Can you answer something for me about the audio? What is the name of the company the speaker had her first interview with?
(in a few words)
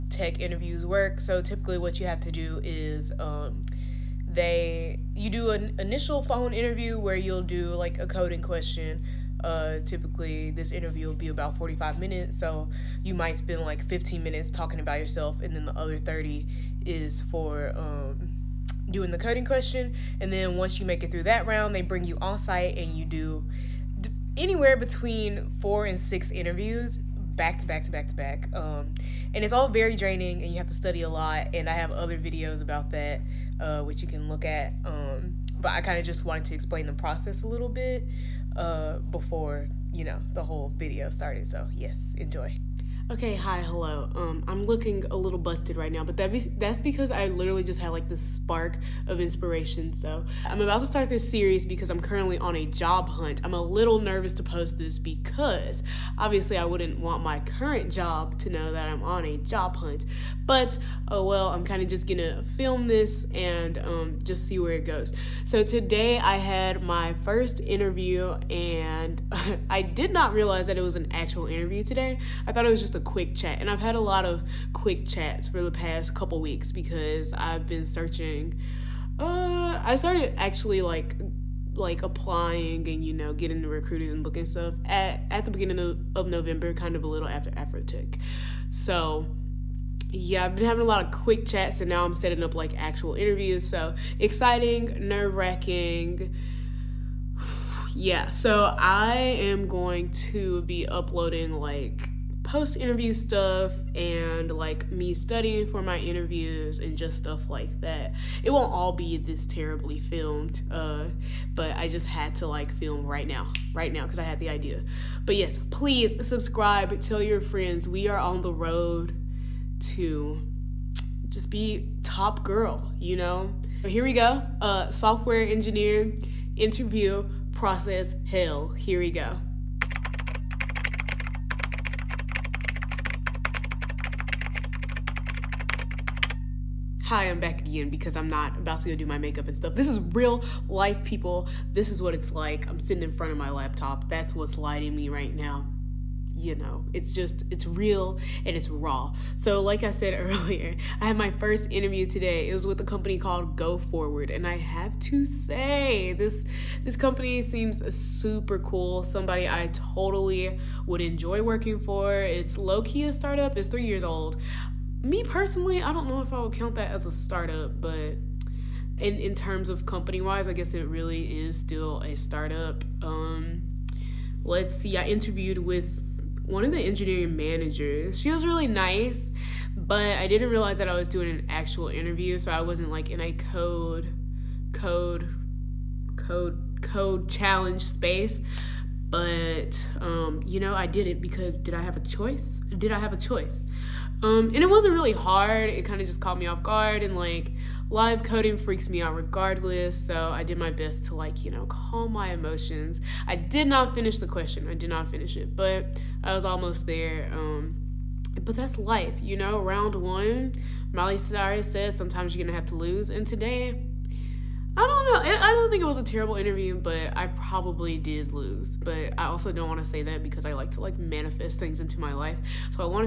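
Go Forward.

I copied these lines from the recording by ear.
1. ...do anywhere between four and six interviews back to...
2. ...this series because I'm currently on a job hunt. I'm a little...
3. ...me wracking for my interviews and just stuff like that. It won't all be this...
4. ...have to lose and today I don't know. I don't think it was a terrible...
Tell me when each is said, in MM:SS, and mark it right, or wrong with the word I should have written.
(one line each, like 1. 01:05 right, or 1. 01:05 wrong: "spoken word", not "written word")
1. 00:23 right
2. 00:51 right
3. 01:44 wrong: "studying", not "wracking"
4. 03:32 right.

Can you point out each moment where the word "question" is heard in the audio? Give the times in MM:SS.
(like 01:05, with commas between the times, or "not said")
00:08, 00:19, 03:24.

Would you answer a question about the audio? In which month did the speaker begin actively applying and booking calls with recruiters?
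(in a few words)
November.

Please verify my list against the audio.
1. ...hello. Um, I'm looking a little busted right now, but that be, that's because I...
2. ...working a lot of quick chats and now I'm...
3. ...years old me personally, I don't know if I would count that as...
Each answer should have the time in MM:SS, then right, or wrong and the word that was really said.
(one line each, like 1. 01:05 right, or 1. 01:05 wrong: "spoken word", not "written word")
1. 00:43 right
2. 01:30 wrong: "having", not "working"
3. 02:43 right.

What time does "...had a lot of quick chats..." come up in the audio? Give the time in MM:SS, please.
01:13.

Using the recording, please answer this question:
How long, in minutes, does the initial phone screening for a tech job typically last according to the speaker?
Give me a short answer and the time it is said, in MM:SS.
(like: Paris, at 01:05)
45 minutes, at 00:11.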